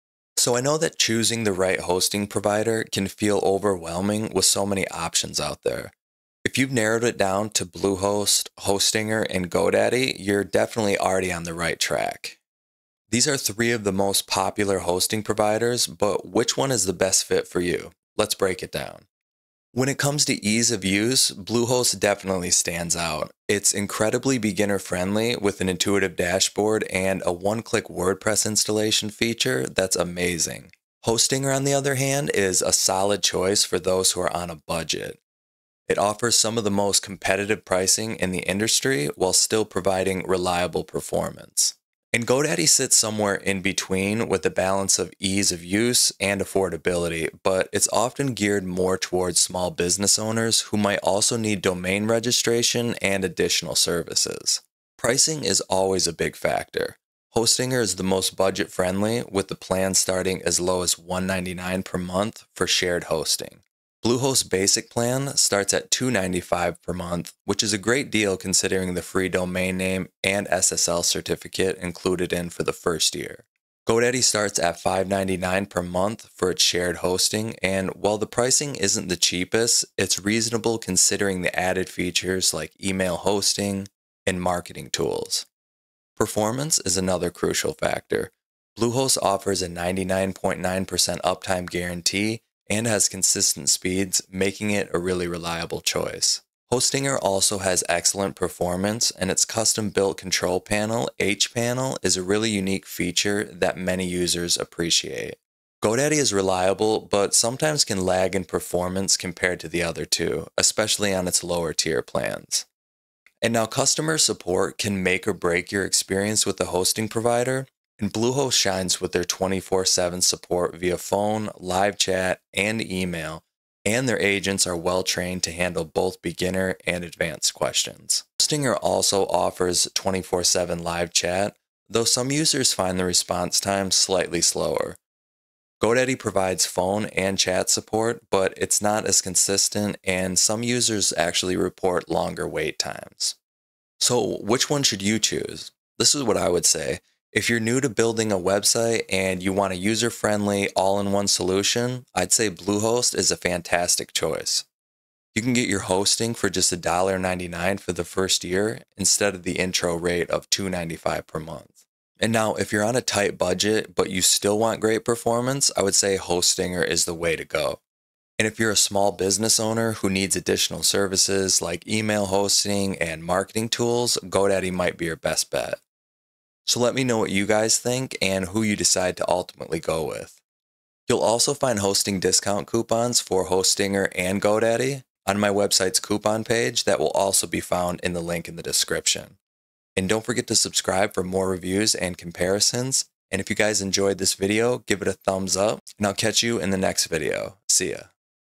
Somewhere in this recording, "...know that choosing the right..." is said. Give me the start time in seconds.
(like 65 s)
0 s.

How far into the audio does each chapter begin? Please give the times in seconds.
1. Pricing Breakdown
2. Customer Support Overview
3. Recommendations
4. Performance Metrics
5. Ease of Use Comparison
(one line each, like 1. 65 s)
1. 65 s
2. 128 s
3. 160 s
4. 97 s
5. 32 s.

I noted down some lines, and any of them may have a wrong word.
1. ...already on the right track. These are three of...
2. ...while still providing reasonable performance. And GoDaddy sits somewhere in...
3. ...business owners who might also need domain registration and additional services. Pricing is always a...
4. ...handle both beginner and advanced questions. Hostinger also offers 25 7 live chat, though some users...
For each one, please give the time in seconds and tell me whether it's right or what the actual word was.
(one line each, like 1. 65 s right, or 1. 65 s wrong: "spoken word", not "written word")
1. 10 s right
2. 39 s wrong: "reliable", not "reasonable"
3. 49 s right
4. 125 s wrong: "24", not "25".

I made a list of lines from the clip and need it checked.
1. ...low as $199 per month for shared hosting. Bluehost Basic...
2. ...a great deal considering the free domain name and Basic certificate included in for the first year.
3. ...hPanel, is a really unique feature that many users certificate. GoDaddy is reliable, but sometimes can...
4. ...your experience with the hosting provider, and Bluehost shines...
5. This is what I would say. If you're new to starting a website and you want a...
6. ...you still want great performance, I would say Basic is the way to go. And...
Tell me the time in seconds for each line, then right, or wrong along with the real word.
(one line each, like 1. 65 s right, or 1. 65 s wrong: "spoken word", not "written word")
1. 60 s right
2. 67 s wrong: "SSL", not "Basic"
3. 101 s wrong: "appreciate", not "certificate"
4. 115 s right
5. 145 s wrong: "building", not "starting"
6. 164 s wrong: "Hostinger", not "Basic".